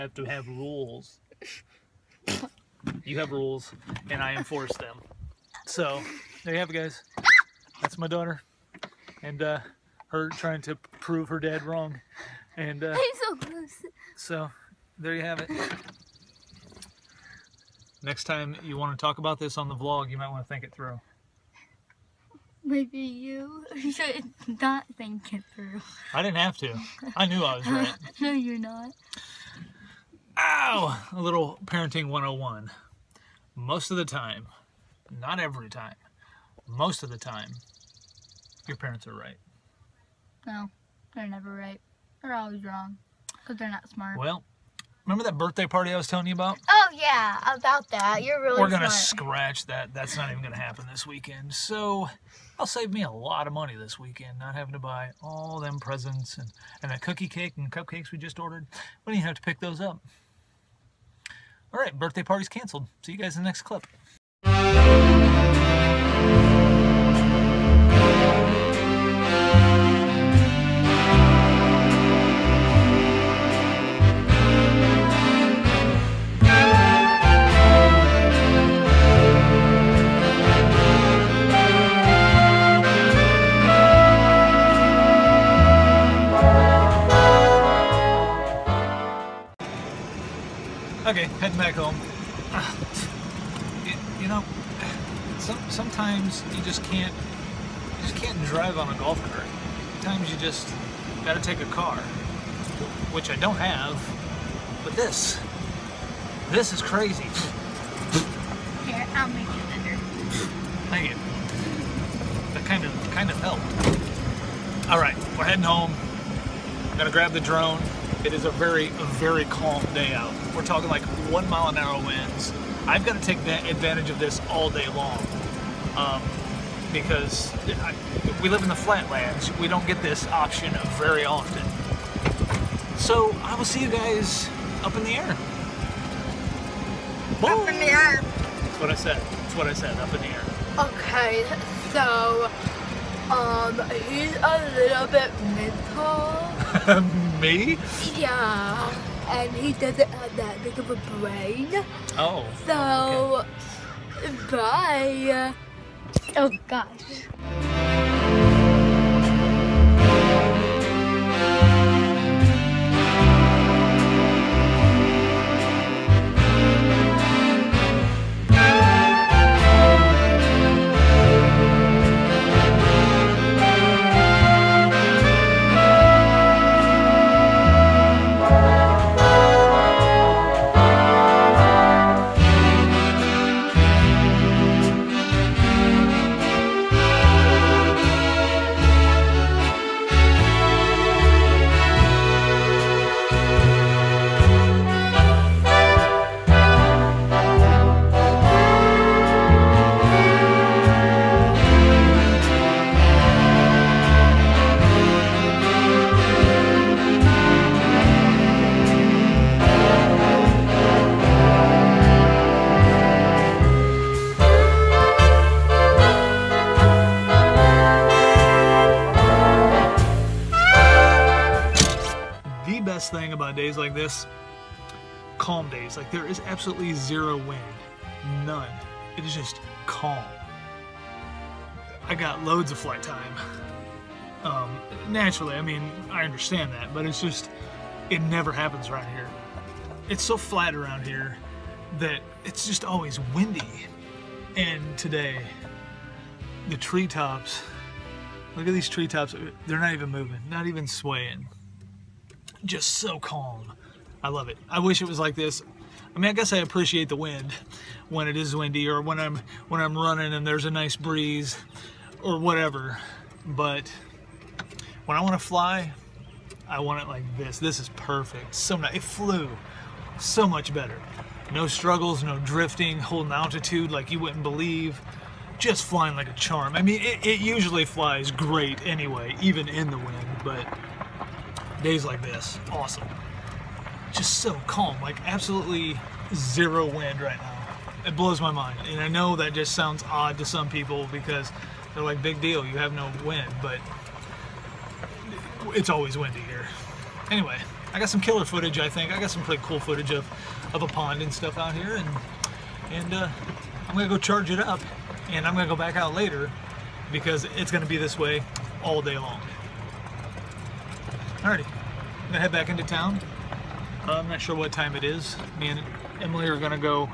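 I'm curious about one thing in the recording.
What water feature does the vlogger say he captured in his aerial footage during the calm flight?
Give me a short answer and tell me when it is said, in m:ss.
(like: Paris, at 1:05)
a pond, at 5:00.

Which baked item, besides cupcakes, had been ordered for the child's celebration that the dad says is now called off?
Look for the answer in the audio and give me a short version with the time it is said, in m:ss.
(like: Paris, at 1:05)
cookie cake, at 0:57.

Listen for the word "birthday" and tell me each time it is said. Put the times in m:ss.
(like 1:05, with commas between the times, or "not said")
0:45, 1:01.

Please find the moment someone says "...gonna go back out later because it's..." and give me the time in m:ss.
5:05.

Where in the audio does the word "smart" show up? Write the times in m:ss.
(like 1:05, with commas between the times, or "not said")
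0:43, 0:48.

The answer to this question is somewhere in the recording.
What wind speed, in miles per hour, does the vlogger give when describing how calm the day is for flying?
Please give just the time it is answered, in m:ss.
2:01.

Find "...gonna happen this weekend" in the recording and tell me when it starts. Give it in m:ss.
0:50.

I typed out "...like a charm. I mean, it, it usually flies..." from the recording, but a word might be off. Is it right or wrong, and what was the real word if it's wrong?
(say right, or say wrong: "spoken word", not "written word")
right.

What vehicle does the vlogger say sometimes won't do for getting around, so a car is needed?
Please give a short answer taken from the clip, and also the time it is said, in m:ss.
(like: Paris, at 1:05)
golf cart, at 1:38.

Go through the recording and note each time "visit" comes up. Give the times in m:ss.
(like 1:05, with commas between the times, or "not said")
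not said.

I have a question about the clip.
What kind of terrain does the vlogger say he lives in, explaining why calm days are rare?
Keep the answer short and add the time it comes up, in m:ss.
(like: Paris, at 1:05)
flatlands, at 2:08.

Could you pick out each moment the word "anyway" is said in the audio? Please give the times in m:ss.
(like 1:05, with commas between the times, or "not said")
4:38, 4:57.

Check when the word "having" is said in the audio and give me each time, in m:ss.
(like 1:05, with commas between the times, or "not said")
0:54.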